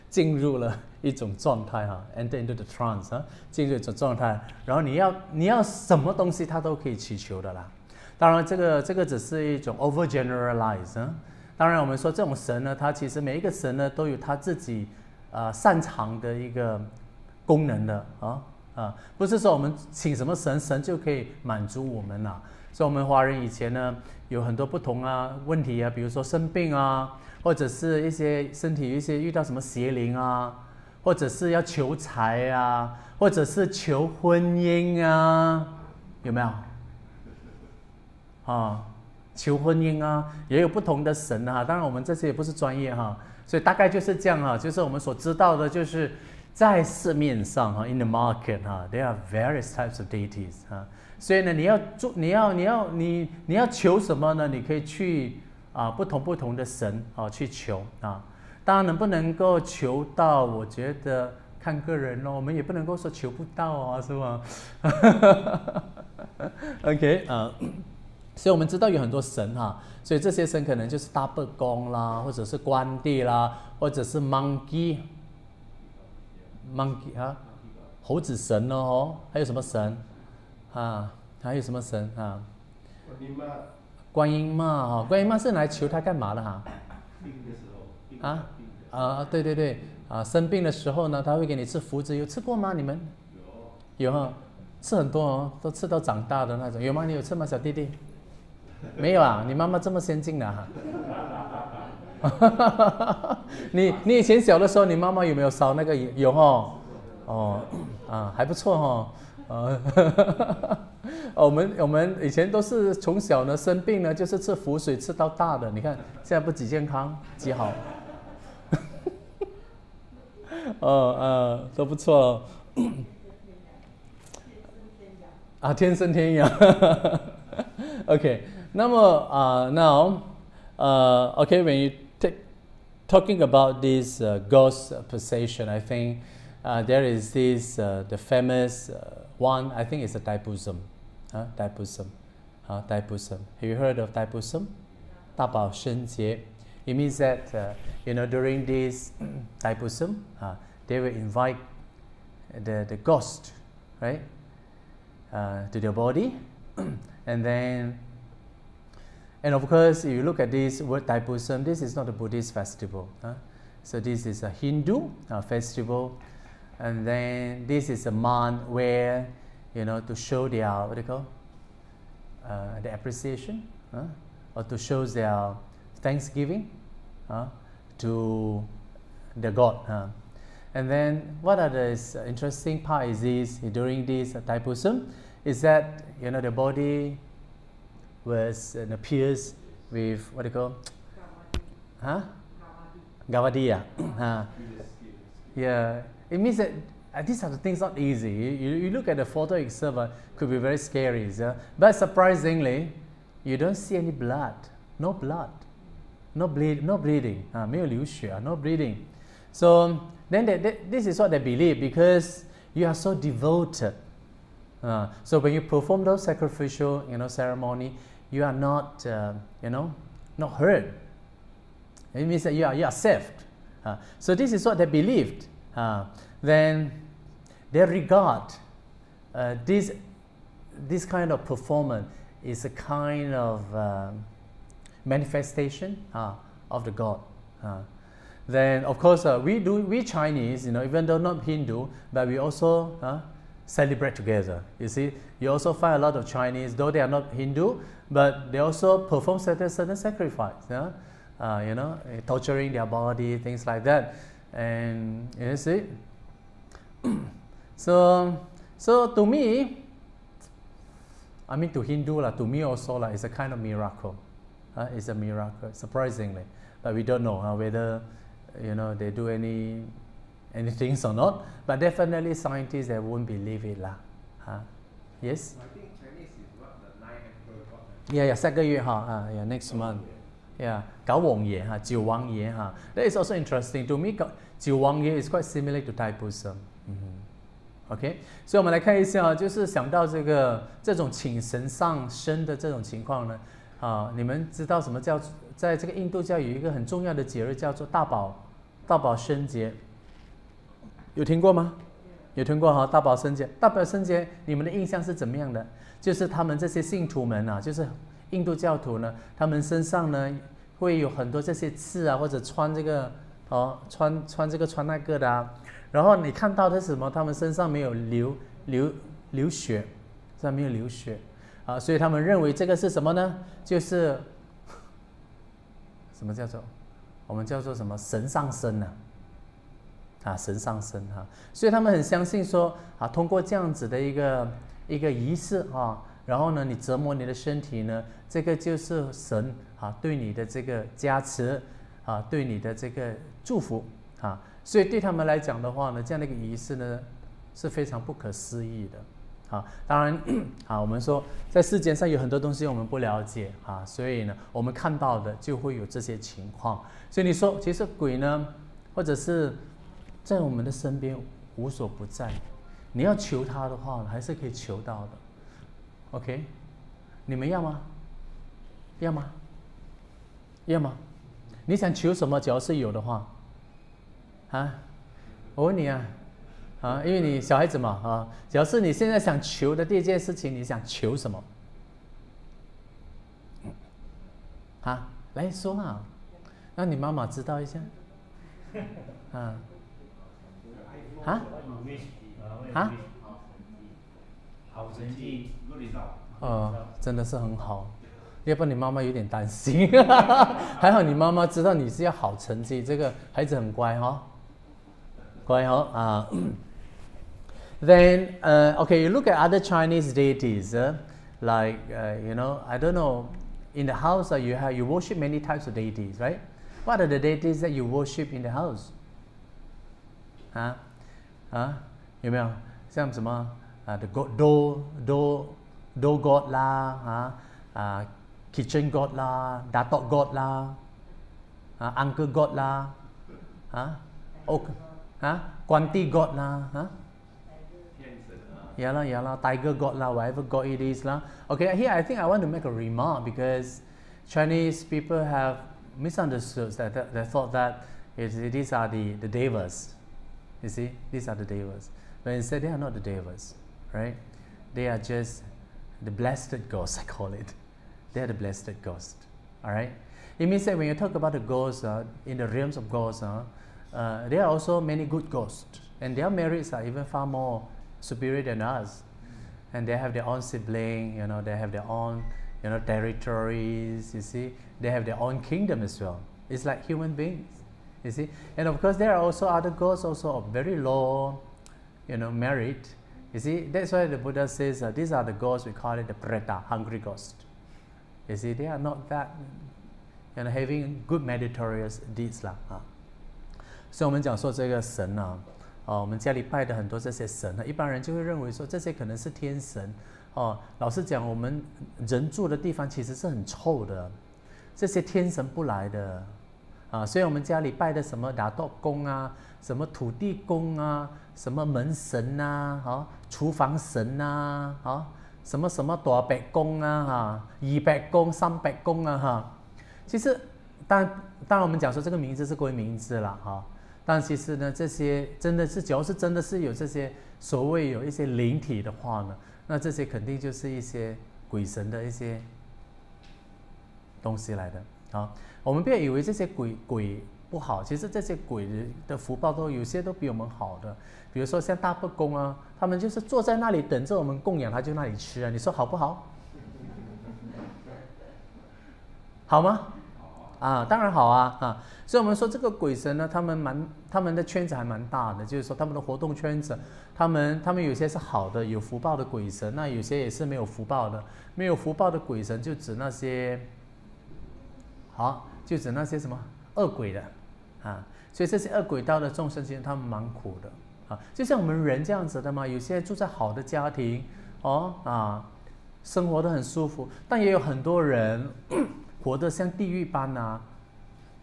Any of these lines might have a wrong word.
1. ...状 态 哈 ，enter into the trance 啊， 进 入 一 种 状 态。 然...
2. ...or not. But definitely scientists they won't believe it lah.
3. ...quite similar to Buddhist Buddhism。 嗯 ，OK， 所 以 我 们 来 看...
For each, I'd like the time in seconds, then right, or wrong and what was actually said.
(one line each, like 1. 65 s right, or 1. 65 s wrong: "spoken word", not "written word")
1. 1 s right
2. 271 s right
3. 285 s wrong: "Thai", not "Buddhist".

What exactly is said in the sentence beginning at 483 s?
You see, that's why the Buddha says these are the ghosts.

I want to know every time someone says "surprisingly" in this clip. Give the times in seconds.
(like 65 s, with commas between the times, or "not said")
201 s, 265 s.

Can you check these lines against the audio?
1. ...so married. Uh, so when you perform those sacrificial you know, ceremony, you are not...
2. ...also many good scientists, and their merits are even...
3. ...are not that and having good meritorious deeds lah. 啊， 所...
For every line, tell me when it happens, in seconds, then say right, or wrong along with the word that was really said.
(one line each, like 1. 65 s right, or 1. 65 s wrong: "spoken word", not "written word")
1. 212 s wrong: "devoted", not "married"
2. 464 s wrong: "ghosts", not "scientists"
3. 488 s right.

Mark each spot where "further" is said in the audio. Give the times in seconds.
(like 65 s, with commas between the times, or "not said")
not said.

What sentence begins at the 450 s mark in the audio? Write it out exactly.
You see, these are the devas.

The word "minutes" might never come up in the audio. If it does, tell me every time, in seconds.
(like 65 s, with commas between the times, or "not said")
not said.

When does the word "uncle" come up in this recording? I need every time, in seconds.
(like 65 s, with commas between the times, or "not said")
431 s.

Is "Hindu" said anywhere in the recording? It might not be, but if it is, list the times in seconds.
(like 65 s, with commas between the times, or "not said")
164 s, 241 s, 247 s, 261 s.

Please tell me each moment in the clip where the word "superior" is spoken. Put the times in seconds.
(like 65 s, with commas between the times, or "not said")
468 s.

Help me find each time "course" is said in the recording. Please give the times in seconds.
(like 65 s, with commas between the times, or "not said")
159 s, 238 s, 478 s.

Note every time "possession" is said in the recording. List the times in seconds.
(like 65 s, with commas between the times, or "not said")
135 s.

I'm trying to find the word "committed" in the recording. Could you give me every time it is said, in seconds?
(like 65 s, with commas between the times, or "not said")
not said.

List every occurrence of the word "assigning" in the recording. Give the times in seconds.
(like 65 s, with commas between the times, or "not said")
not said.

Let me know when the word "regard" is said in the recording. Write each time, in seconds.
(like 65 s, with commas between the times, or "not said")
227 s.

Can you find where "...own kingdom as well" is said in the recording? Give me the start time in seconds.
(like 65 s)
475 s.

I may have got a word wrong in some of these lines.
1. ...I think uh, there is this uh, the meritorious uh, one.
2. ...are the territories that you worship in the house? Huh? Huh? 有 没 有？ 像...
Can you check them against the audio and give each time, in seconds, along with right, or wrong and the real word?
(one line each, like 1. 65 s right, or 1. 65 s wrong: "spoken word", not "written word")
1. 135 s wrong: "famous", not "meritorious"
2. 417 s wrong: "deities", not "territories".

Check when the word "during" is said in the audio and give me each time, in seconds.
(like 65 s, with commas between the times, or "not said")
148 s, 183 s.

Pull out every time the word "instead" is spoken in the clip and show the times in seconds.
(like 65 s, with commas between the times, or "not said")
452 s.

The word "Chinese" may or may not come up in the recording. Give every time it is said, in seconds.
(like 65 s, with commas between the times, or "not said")
240 s, 246 s, 409 s, 444 s.